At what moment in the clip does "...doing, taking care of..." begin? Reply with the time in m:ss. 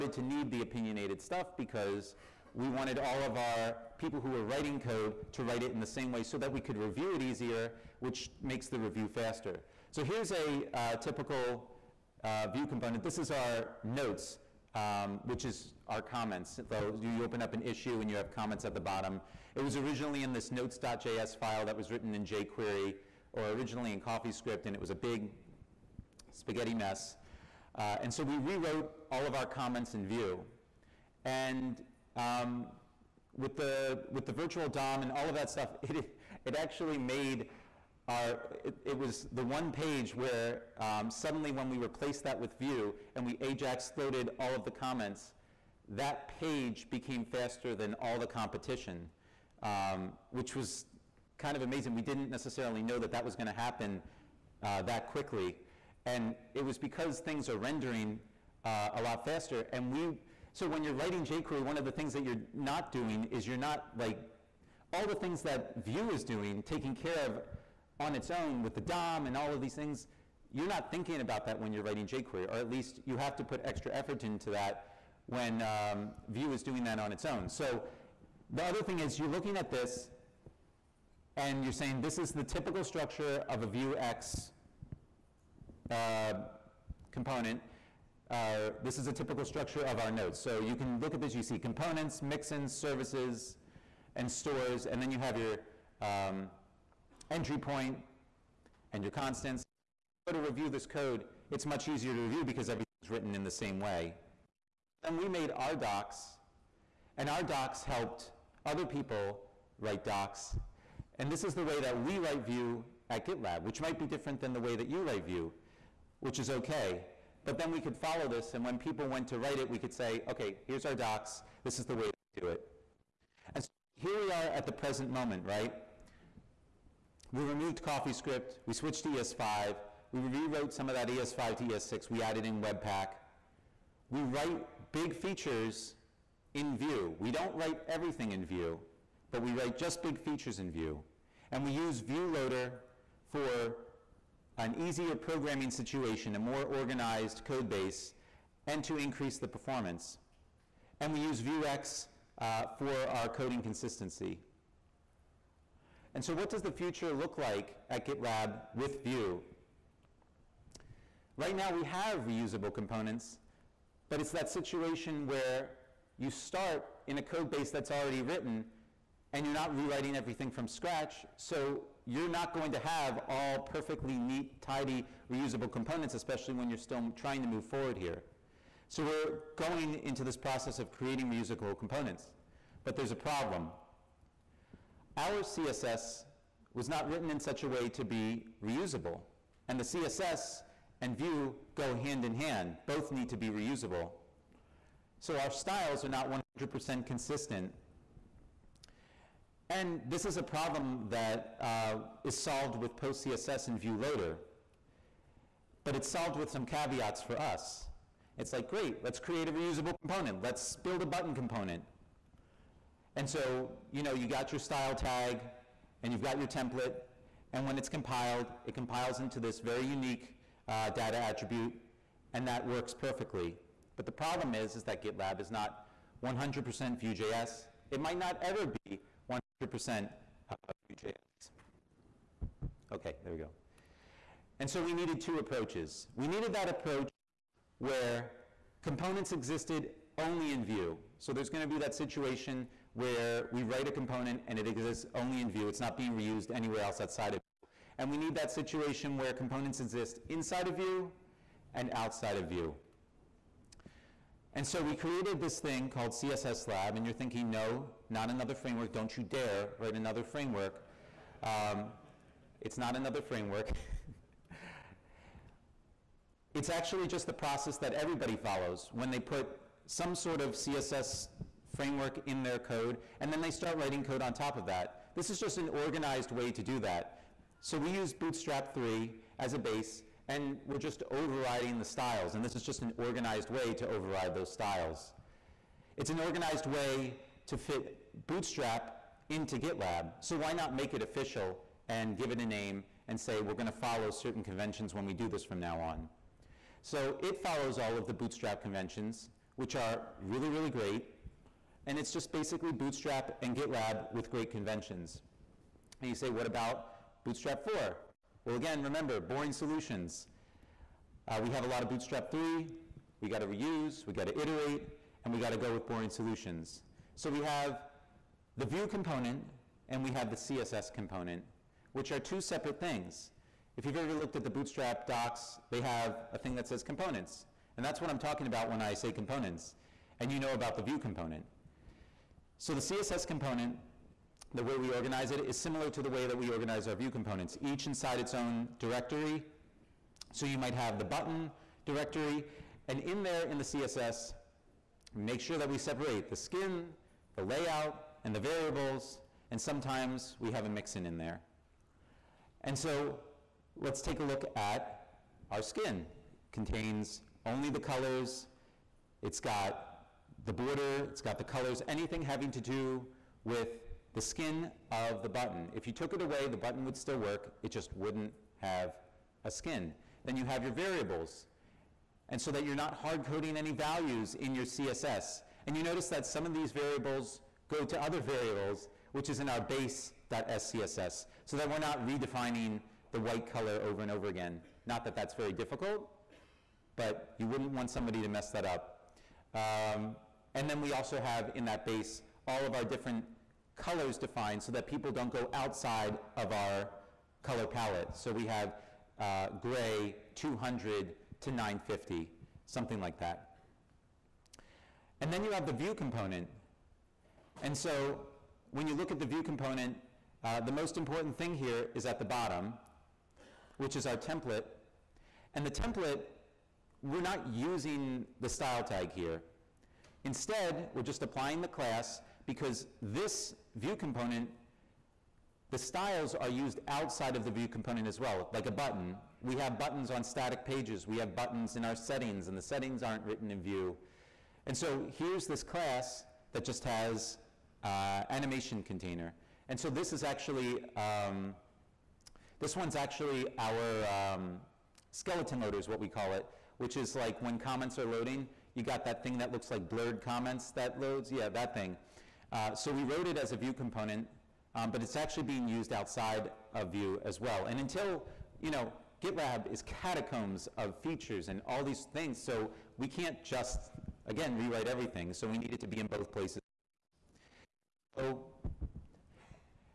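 1:06.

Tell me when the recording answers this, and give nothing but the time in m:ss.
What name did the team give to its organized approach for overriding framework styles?
4:16.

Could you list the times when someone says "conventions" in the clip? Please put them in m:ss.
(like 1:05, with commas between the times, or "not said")
4:54, 4:58, 5:04.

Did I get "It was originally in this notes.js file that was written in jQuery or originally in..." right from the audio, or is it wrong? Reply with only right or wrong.
right.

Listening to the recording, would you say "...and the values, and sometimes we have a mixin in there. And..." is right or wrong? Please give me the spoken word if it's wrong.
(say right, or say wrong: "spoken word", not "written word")
wrong: "variables", not "values".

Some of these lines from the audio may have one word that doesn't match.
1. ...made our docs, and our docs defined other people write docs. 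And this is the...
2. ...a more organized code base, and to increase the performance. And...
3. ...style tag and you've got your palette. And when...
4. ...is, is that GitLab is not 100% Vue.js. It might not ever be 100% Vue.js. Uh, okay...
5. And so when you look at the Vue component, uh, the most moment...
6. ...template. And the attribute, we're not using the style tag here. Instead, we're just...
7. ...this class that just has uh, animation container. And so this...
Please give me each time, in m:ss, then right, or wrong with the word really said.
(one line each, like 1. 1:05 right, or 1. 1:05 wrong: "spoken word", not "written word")
1. 1:45 wrong: "helped", not "defined"
2. 2:26 right
3. 3:34 wrong: "template", not "palette"
4. 3:44 right
5. 6:47 wrong: "important", not "moment"
6. 6:54 wrong: "template", not "attribute"
7. 7:15 right.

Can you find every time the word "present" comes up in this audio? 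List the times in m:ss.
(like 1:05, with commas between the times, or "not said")
2:04.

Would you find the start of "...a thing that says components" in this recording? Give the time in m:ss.
5:26.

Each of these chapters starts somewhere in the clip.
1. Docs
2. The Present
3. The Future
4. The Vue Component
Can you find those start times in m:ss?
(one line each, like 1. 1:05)
1. 1:42
2. 2:02
3. 2:34
4. 6:43.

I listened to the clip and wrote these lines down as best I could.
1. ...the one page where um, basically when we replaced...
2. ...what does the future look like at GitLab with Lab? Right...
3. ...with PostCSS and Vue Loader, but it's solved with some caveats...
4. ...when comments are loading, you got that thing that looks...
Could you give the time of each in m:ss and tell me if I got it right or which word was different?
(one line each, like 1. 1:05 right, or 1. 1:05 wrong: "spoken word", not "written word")
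1. 0:39 wrong: "suddenly", not "basically"
2. 2:36 wrong: "Vue", not "Lab"
3. 3:22 right
4. 7:27 right.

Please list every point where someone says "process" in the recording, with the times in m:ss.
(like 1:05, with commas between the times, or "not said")
3:00, 4:27.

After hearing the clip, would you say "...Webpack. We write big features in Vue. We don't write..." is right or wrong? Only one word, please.
right.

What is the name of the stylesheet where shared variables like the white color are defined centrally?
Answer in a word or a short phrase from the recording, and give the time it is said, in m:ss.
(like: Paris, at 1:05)
base.scss, at 6:19.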